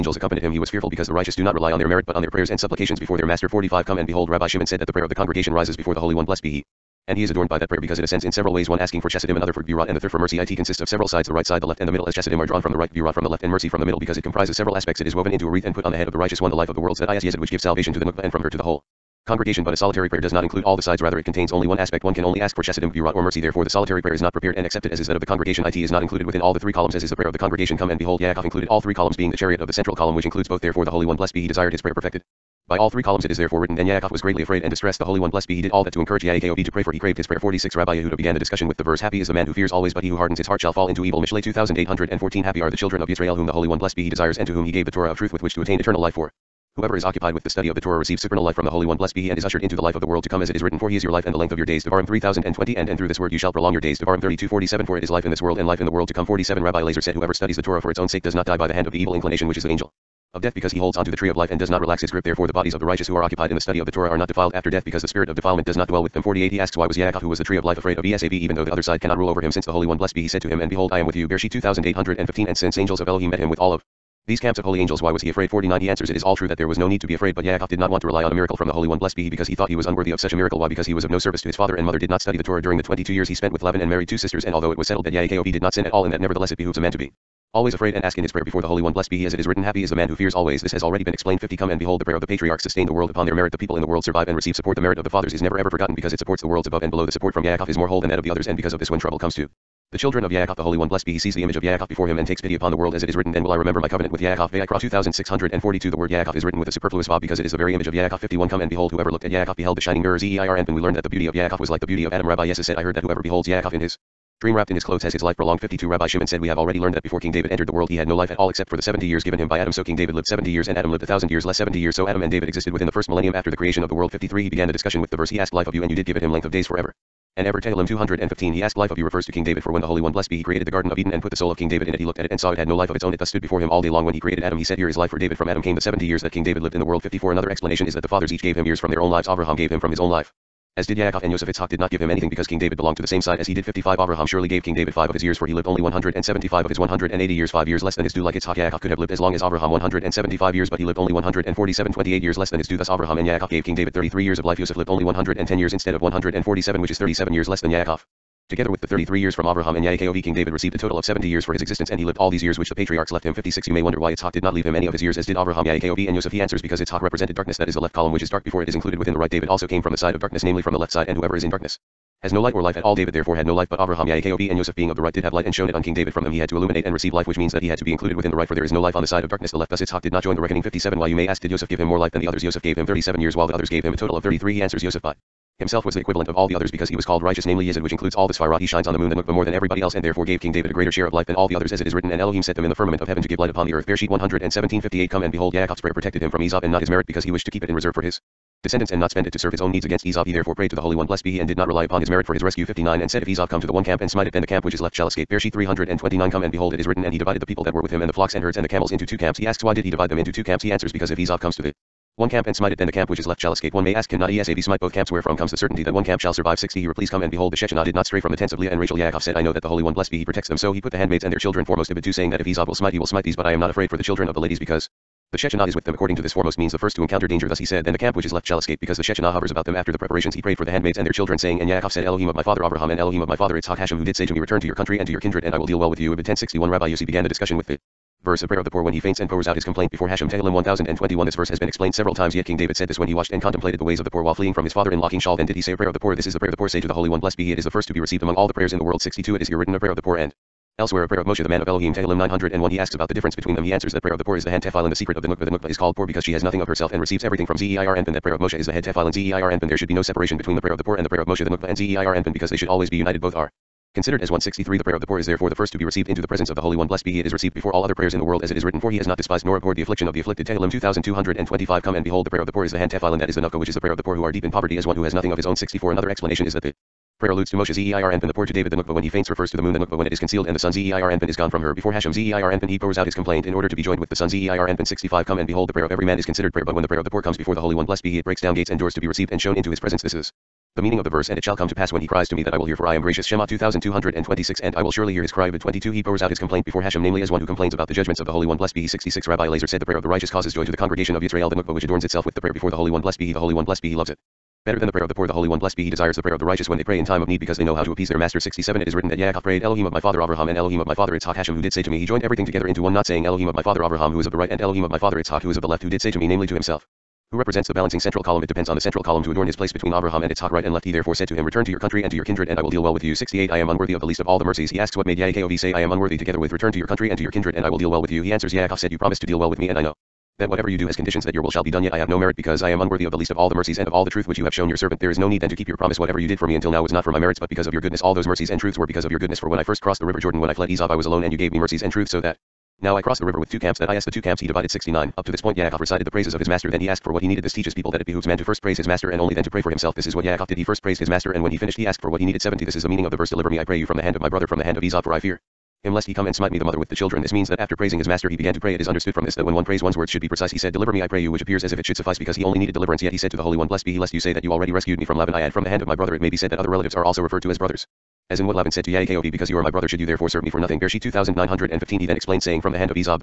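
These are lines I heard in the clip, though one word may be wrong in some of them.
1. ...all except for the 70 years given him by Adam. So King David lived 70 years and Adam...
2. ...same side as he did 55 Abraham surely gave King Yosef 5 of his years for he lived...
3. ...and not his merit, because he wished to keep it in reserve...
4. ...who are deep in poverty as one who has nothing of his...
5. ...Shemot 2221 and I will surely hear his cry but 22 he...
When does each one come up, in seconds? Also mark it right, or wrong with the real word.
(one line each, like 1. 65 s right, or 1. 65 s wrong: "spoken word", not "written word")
1. 118 s right
2. 143 s wrong: "David", not "Yosef"
3. 196 s right
4. 274 s right
5. 293 s wrong: "2226", not "2221".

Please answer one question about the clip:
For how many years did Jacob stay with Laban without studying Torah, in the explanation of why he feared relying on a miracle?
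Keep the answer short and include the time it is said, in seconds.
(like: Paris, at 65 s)
22, at 82 s.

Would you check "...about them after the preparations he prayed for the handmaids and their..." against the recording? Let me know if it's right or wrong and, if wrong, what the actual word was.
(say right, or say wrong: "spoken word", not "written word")
right.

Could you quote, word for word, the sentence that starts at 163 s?
You may wonder why Itzhak did not leave him any of his years as did Abraham, Yaakov, and Yosef.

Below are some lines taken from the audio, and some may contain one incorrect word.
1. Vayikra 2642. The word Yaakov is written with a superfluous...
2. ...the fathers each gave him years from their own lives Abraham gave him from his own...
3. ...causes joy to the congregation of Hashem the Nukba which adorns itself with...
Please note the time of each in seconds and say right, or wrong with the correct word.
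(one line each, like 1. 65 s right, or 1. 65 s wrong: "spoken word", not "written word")
1. 104 s right
2. 138 s right
3. 300 s wrong: "Israel", not "Hashem".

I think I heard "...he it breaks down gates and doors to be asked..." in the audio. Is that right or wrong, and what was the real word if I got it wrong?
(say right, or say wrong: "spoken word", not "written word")
wrong: "received", not "asked".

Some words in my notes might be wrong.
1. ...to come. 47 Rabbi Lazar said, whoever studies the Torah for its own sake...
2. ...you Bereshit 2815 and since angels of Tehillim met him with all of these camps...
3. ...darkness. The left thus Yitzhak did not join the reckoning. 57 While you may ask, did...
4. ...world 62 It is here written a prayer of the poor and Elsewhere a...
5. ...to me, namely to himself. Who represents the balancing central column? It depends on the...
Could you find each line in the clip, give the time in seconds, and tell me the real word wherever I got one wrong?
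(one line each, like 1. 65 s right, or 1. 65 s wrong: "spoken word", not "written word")
1. 56 s right
2. 71 s wrong: "Elohim", not "Tehillim"
3. 179 s right
4. 248 s right
5. 316 s right.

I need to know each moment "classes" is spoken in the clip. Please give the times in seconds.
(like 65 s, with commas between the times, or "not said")
not said.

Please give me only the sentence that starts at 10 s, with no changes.
It consists of several sides, the right side, the left, and the middle.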